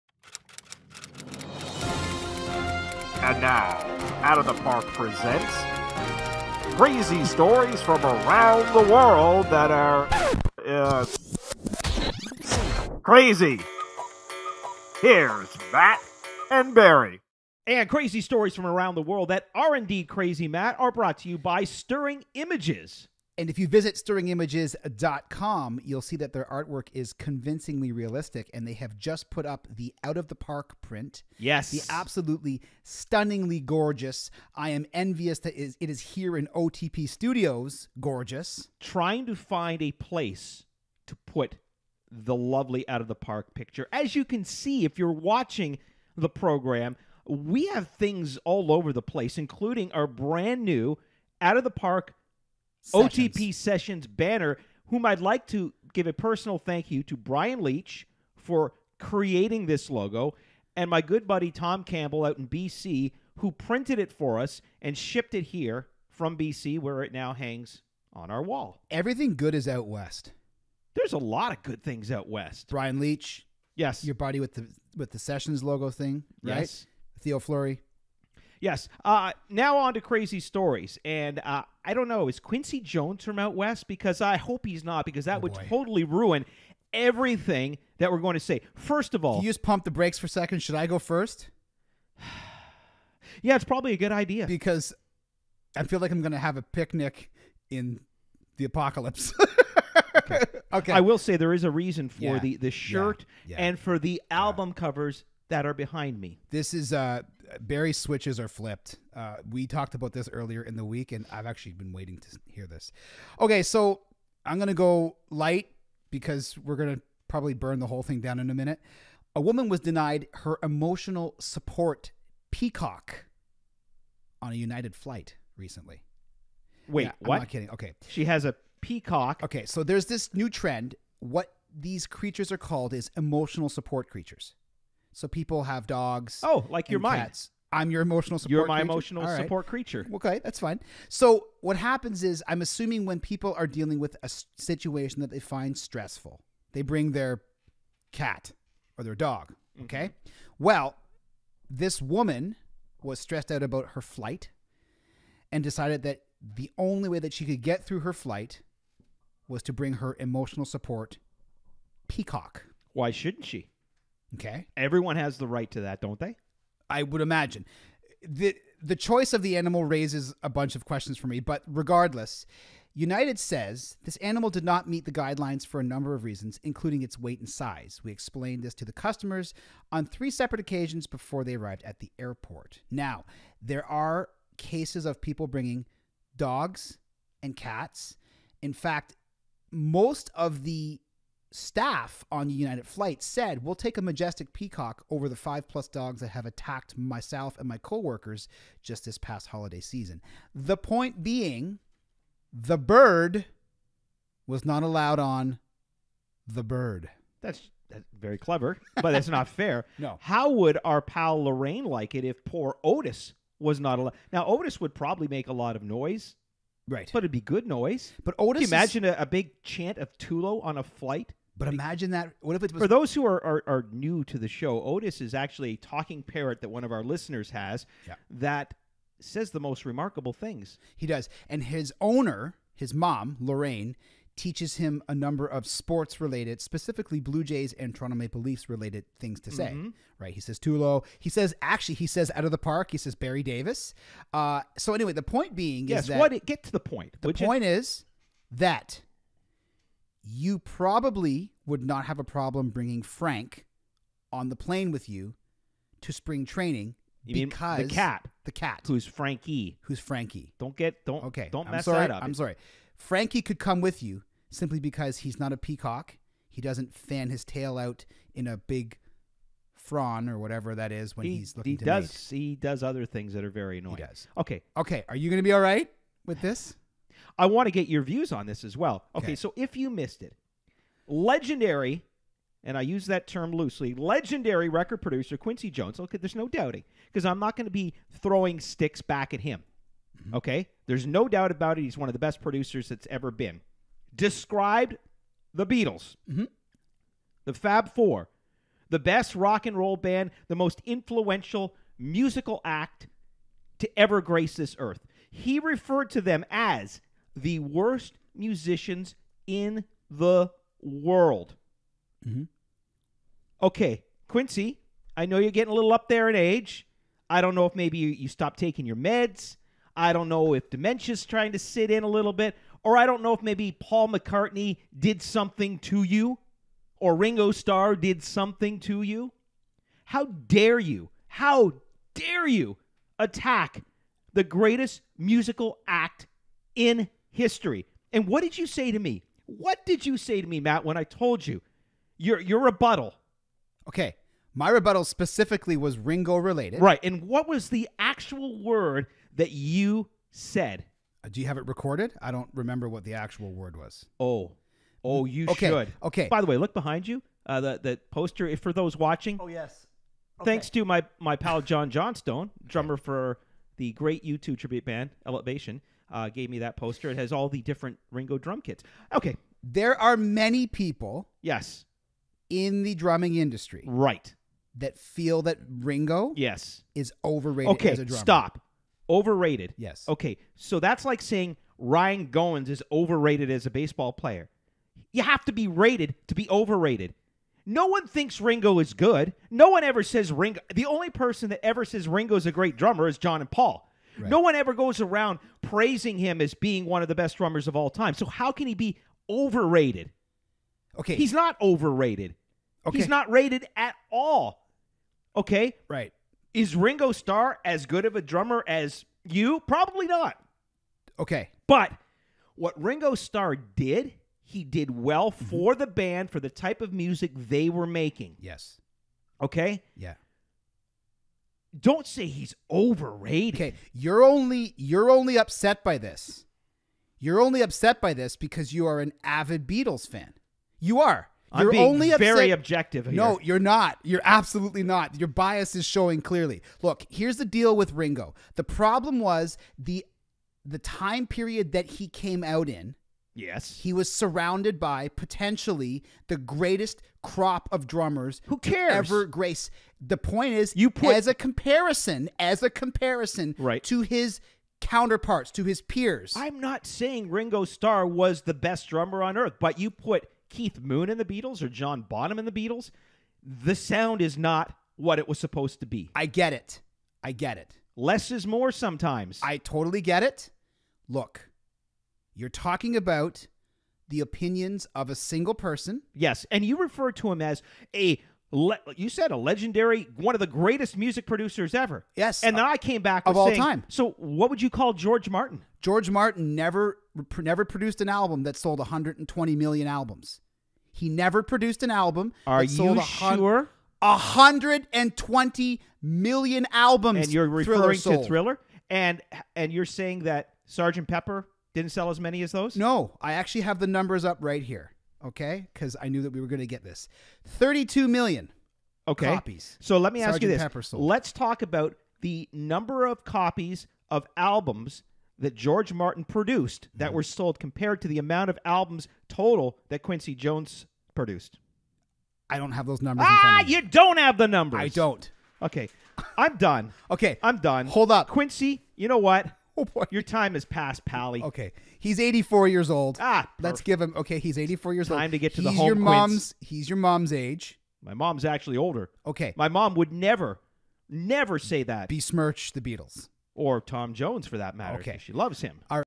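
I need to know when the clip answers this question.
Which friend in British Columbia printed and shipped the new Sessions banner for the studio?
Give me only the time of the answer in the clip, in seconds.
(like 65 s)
61 s.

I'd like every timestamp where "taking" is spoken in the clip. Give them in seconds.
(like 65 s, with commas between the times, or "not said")
318 s.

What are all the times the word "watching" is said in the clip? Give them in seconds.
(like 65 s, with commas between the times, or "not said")
45 s, 358 s.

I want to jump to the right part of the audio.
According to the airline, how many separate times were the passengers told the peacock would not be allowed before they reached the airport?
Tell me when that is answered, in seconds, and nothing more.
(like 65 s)
180 s.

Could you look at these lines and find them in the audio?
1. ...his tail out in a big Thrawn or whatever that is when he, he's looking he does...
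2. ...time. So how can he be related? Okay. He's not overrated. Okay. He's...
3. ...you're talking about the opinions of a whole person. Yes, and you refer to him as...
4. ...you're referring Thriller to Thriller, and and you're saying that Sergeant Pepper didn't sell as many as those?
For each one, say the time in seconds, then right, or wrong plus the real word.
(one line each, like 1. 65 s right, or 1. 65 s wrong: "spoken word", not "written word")
1. 267 s right
2. 397 s wrong: "overrated", not "related"
3. 472 s wrong: "single", not "whole"
4. 497 s right.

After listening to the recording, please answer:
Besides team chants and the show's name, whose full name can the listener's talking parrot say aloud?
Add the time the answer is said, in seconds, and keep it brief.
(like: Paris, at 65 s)
Barry Davis, at 243 s.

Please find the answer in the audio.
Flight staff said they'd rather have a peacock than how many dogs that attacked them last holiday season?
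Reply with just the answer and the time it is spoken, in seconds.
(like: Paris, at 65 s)
5 plus, at 195 s.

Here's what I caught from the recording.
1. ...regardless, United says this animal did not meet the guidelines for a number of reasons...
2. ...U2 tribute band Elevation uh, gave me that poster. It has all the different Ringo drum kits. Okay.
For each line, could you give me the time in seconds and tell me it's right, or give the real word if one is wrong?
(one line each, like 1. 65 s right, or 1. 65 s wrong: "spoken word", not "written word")
1. 171 s right
2. 364 s right.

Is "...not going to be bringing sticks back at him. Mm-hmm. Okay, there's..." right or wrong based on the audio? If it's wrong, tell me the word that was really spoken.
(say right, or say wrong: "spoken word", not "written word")
wrong: "throwing", not "bringing".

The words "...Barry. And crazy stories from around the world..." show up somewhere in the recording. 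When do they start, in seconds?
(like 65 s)
16 s.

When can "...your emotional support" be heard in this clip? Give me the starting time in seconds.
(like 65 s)
137 s.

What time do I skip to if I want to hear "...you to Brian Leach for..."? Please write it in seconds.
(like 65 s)
56 s.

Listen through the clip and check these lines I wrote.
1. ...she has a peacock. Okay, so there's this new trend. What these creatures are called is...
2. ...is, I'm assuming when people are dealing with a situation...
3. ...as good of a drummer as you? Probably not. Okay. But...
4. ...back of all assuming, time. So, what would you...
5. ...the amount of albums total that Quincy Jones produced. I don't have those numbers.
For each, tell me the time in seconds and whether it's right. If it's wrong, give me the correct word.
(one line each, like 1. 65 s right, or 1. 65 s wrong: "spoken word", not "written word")
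1. 128 s right
2. 142 s right
3. 407 s right
4. 483 s wrong: "saying", not "assuming"
5. 518 s right.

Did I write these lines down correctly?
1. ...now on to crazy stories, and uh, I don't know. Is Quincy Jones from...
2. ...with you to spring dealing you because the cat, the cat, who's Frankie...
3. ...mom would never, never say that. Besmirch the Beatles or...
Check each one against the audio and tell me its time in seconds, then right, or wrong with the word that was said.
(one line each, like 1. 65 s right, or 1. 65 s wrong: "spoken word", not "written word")
1. 79 s right
2. 254 s wrong: "training", not "dealing"
3. 539 s right.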